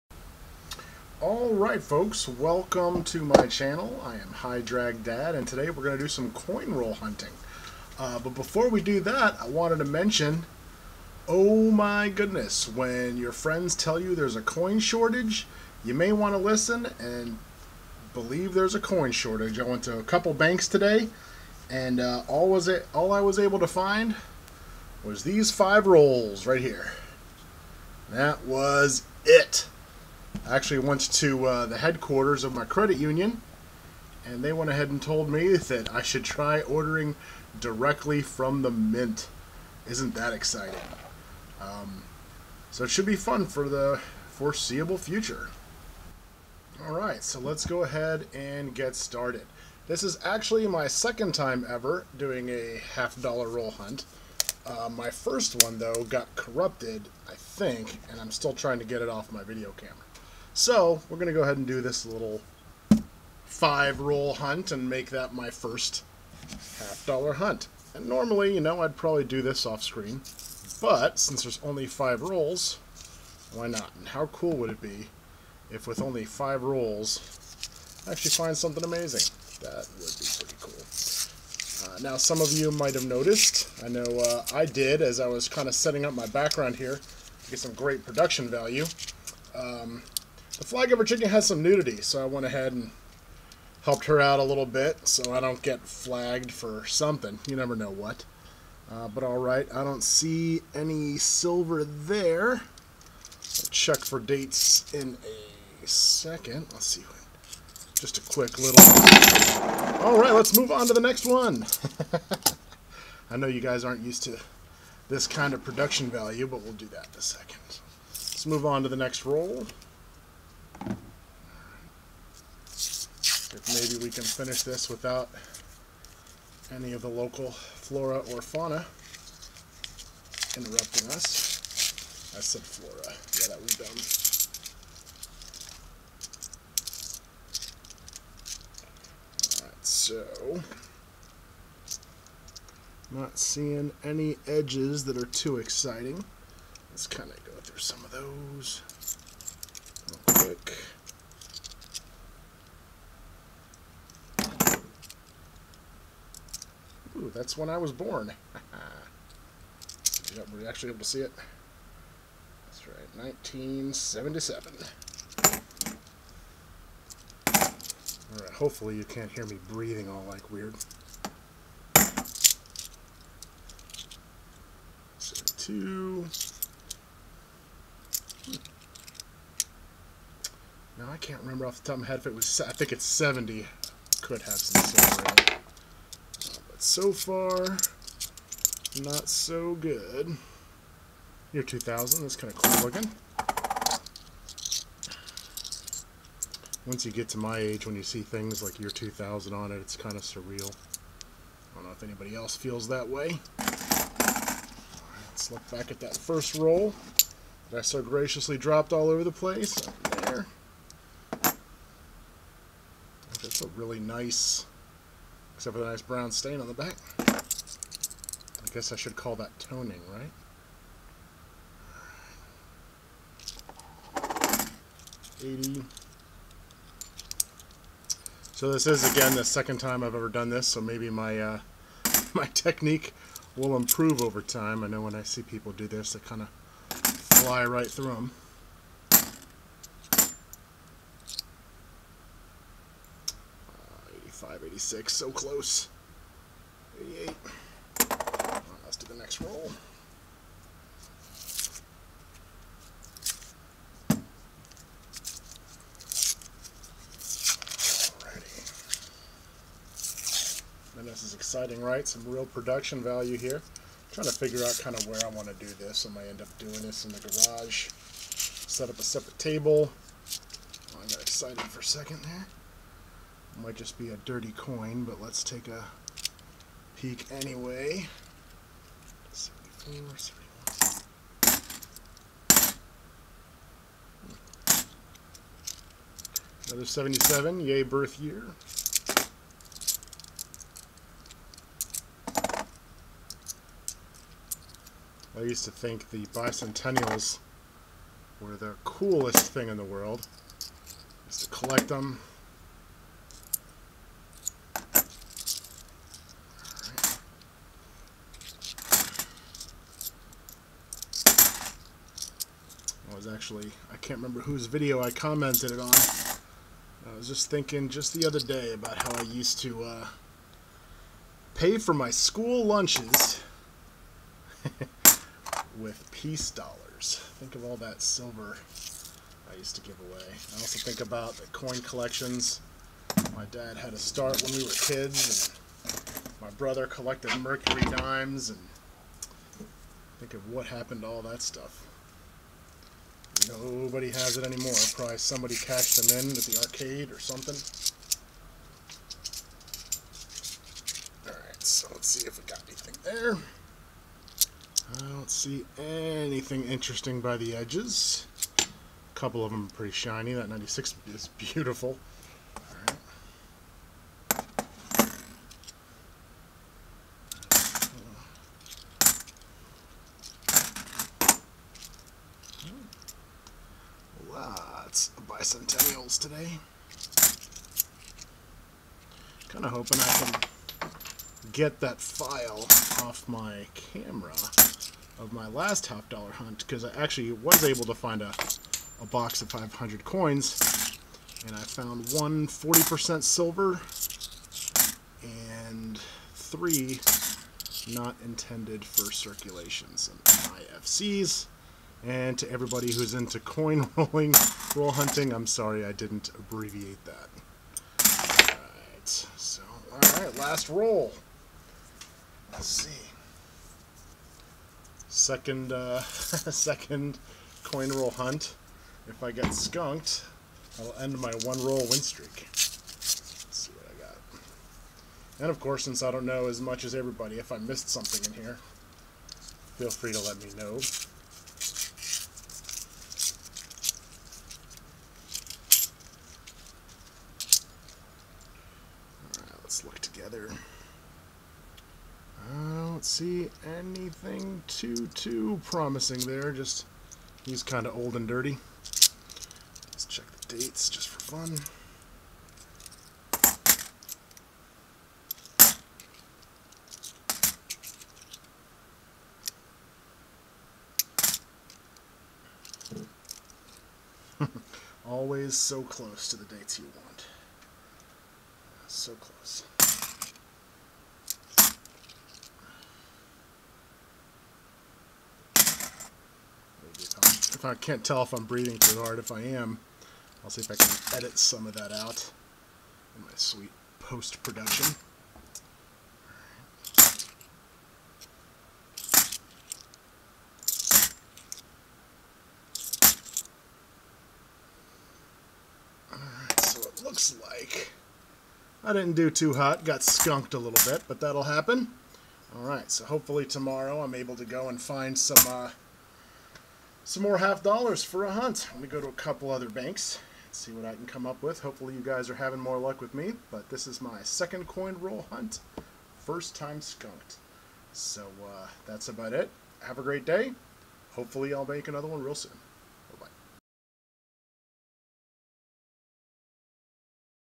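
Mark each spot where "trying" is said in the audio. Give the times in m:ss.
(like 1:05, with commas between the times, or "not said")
0:58, 4:24.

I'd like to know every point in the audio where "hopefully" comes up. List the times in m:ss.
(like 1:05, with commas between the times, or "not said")
2:48, 8:23, 8:31, 8:41.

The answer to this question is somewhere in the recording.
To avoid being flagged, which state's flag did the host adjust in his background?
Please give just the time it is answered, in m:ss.
1:30.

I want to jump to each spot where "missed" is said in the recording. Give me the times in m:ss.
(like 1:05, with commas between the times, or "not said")
7:07.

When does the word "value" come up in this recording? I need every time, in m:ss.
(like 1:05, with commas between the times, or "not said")
1:28, 1:56, 4:23.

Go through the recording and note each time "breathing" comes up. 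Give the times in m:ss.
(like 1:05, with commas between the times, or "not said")
2:49, 7:58.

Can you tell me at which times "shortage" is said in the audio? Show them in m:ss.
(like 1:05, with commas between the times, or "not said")
0:14, 0:19.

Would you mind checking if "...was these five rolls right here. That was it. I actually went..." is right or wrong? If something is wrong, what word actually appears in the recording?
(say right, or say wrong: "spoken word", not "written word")
right.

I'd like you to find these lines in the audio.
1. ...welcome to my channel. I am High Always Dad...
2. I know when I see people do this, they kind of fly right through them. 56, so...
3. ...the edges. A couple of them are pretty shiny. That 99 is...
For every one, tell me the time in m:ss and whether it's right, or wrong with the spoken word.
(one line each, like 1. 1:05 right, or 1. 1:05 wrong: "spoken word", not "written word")
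1. 0:02 wrong: "Drag", not "Always"
2. 3:54 wrong: "86", not "56"
3. 5:57 wrong: "96", not "99".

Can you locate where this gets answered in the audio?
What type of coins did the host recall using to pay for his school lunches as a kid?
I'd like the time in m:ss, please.
5:26.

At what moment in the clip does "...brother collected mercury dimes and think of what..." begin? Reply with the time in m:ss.
5:36.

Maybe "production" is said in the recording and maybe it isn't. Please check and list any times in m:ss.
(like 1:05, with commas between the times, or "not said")
1:28, 1:55, 4:22, 8:03.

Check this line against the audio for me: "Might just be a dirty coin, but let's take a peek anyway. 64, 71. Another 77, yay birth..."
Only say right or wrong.
wrong.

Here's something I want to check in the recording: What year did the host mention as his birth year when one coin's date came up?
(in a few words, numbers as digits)
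1977.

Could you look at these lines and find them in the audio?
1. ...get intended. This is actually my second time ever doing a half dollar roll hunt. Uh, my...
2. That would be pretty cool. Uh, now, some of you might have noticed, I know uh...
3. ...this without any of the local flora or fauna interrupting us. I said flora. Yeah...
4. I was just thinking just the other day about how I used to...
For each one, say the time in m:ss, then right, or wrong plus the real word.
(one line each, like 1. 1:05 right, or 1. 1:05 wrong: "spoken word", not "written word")
1. 0:48 wrong: "started", not "intended"
2. 1:19 right
3. 2:04 right
4. 5:17 right.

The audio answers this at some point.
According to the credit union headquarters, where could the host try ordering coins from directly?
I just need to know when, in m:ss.
0:38.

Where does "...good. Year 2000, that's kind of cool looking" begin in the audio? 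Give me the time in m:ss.
3:09.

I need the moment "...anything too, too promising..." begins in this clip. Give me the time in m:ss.
7:23.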